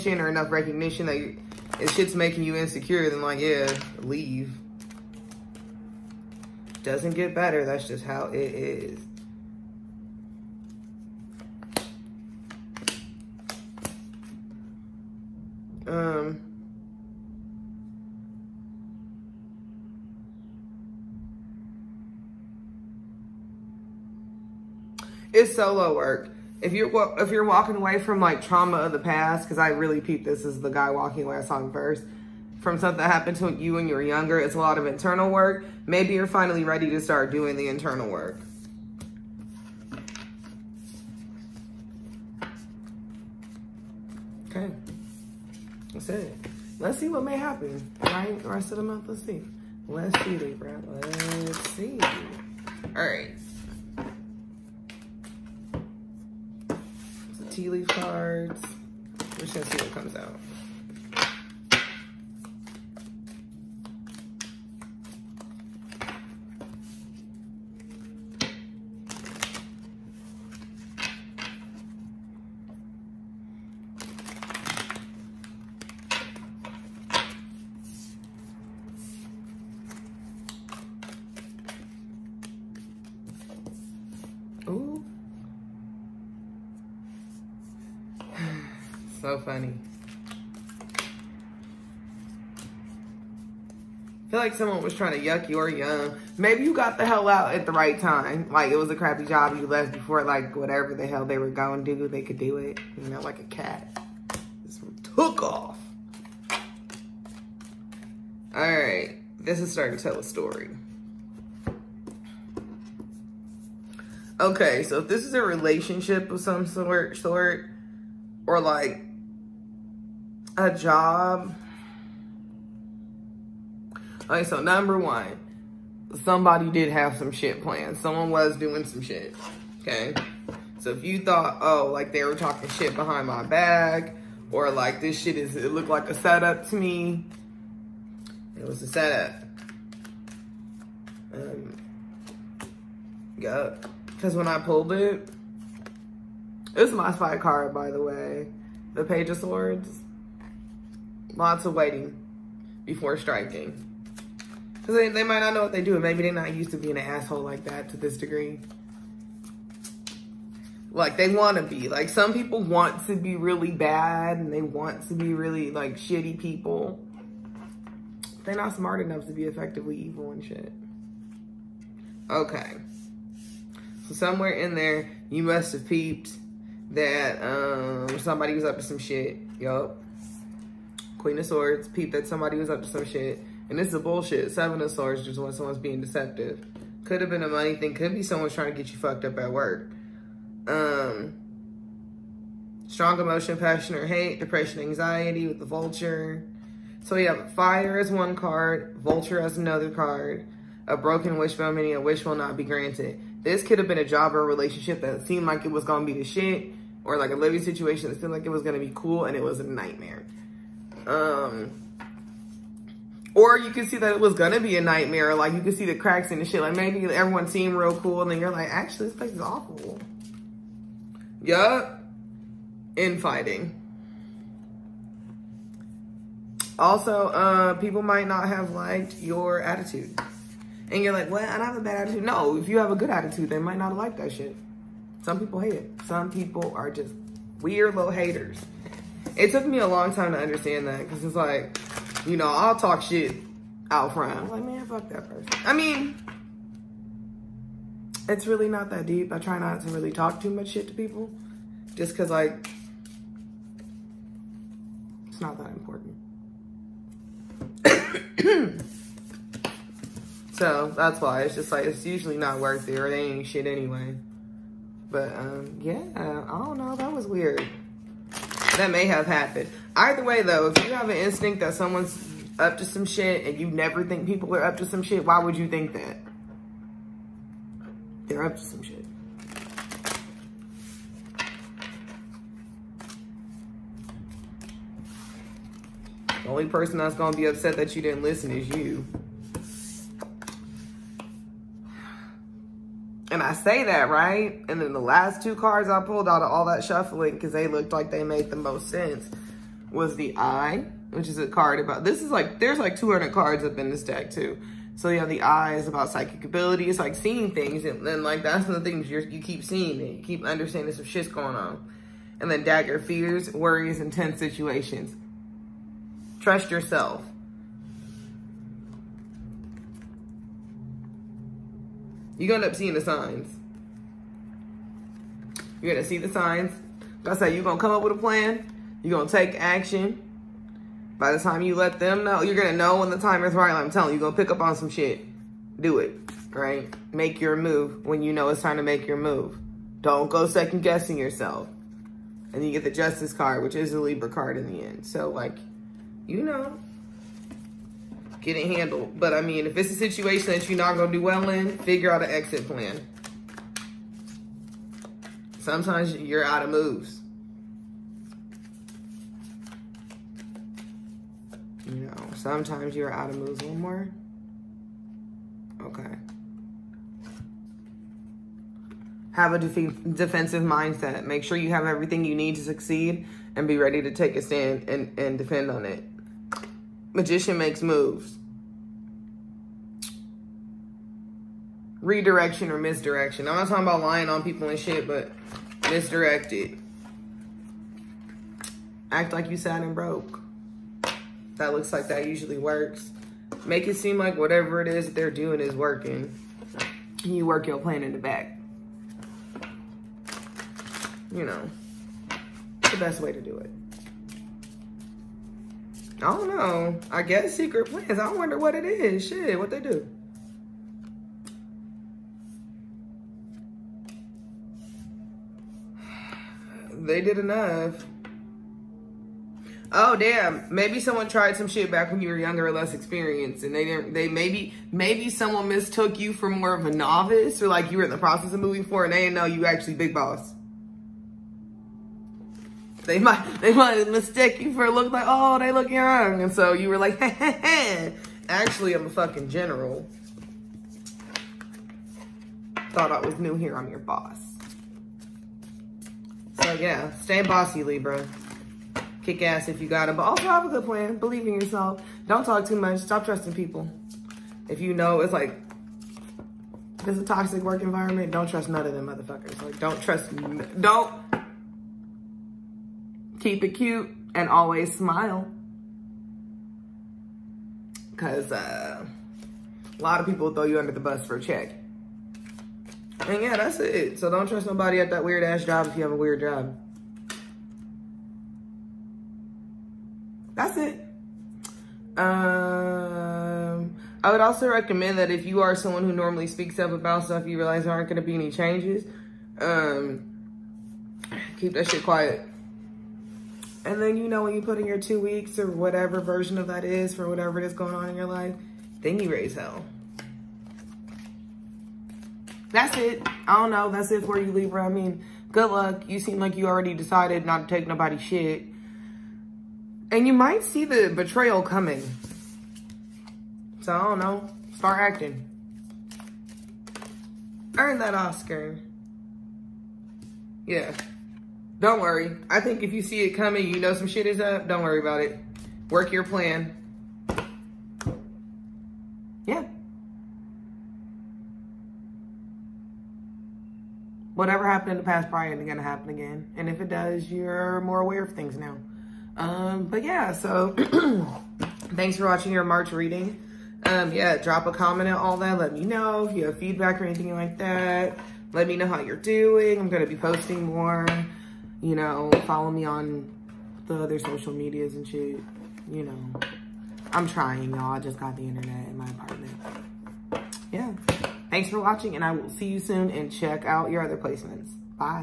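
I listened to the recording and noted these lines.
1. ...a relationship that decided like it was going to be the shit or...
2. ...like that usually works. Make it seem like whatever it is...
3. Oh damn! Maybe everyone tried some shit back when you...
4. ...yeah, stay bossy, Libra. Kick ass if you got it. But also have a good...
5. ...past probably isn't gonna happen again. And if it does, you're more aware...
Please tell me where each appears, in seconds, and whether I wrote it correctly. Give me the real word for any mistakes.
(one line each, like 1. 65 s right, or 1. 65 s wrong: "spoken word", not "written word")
1. 204 s wrong: "seemed", not "decided"
2. 391 s right
3. 419 s wrong: "someone", not "everyone"
4. 446 s right
5. 535 s right.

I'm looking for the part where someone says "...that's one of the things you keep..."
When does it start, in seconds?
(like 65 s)
308 s.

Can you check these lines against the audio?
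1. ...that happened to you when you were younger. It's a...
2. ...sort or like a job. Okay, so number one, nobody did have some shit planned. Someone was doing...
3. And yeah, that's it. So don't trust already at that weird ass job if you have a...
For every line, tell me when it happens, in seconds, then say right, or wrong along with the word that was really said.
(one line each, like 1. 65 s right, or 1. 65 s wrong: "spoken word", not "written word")
1. 32 s right
2. 117 s wrong: "somebody", not "nobody"
3. 473 s wrong: "nobody", not "already".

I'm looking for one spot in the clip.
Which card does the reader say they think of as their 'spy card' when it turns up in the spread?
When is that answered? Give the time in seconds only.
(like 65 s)
148 s.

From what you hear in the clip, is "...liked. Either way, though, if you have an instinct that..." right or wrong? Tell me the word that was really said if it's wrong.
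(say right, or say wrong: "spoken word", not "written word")
wrong: "happened", not "liked".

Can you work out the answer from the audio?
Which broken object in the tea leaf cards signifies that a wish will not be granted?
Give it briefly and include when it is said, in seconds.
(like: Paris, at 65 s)
Wishbone, at 200 s.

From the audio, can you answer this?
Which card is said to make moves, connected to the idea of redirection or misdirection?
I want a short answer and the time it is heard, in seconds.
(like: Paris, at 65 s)
Magician, at 377 s.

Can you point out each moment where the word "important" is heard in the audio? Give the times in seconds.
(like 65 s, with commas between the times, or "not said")
255 s.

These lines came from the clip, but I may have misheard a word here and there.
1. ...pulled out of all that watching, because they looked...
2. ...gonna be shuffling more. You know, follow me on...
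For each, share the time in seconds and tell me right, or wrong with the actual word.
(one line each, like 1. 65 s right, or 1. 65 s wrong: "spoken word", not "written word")
1. 296 s wrong: "shuffling", not "watching"
2. 549 s wrong: "posting", not "shuffling".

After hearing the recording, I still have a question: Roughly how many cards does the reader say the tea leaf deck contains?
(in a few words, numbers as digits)
200.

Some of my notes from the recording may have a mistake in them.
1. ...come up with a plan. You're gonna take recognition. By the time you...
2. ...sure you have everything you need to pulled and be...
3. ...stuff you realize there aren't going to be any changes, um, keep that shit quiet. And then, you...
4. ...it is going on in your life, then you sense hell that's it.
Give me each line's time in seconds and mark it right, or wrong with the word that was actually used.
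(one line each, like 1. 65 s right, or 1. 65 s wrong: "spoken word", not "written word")
1. 327 s wrong: "action", not "recognition"
2. 371 s wrong: "succeed", not "pulled"
3. 487 s right
4. 497 s wrong: "raise", not "sense".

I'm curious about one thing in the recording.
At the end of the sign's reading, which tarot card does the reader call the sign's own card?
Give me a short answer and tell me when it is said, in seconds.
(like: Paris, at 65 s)
Justice, at 342 s.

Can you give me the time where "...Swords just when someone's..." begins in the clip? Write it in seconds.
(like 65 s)
184 s.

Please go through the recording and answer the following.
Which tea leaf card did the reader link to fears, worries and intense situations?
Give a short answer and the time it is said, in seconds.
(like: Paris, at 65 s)
Dagger, at 312 s.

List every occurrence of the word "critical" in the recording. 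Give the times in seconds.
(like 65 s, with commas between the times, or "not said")
not said.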